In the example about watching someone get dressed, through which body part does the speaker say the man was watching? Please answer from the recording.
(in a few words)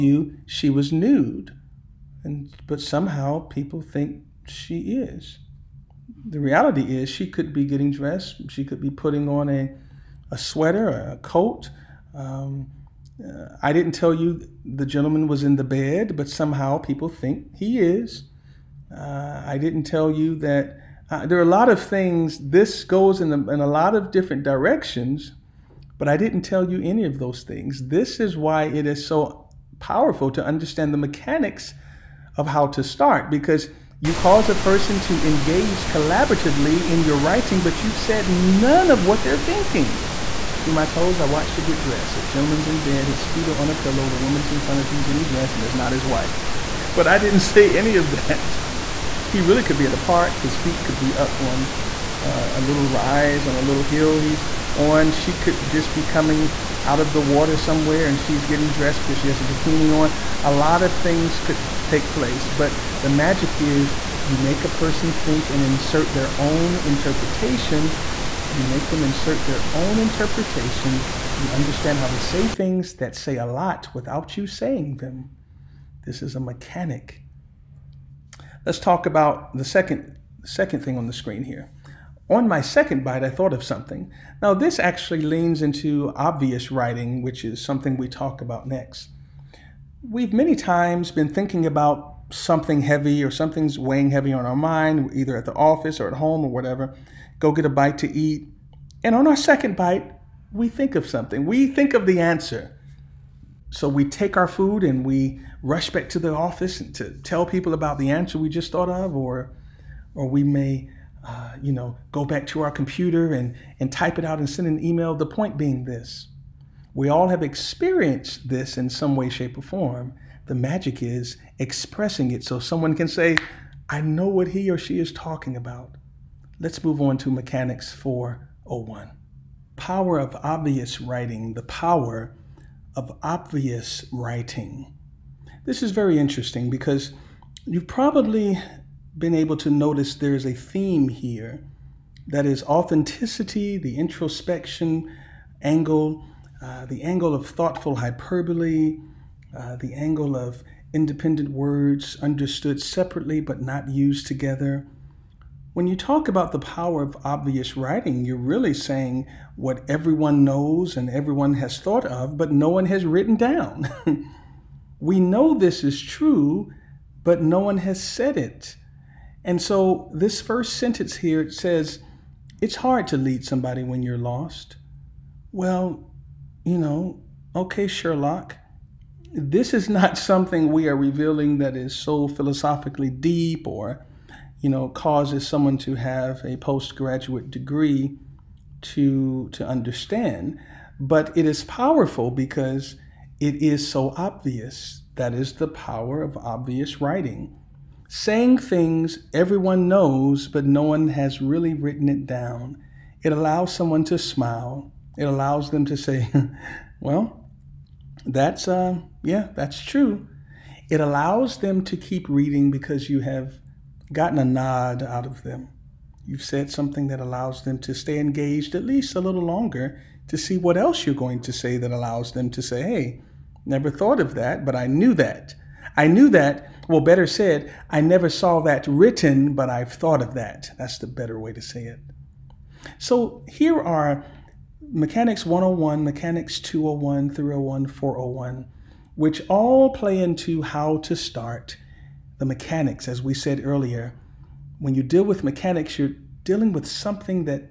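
Toes.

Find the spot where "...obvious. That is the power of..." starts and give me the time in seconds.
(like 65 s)
194 s.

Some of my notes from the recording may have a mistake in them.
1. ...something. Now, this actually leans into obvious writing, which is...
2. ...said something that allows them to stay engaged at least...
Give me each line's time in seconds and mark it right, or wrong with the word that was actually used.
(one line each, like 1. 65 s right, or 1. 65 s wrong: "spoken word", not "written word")
1. 83 s right
2. 216 s right.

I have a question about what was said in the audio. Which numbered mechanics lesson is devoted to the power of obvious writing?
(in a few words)
Mechanics 401.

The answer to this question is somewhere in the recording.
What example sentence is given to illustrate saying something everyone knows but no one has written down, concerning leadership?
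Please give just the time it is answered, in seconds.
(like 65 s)
172 s.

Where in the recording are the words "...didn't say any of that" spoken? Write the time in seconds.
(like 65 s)
47 s.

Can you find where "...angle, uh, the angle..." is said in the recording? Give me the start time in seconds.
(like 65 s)
145 s.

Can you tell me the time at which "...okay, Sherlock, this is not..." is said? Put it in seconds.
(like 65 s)
177 s.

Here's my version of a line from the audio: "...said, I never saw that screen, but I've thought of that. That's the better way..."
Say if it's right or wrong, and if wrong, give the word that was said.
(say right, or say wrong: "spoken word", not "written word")
wrong: "written", not "screen".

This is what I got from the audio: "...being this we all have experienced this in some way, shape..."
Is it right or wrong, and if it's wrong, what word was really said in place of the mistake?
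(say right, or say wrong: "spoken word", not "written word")
right.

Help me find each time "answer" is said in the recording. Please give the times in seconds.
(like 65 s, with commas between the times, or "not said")
102 s, 108 s.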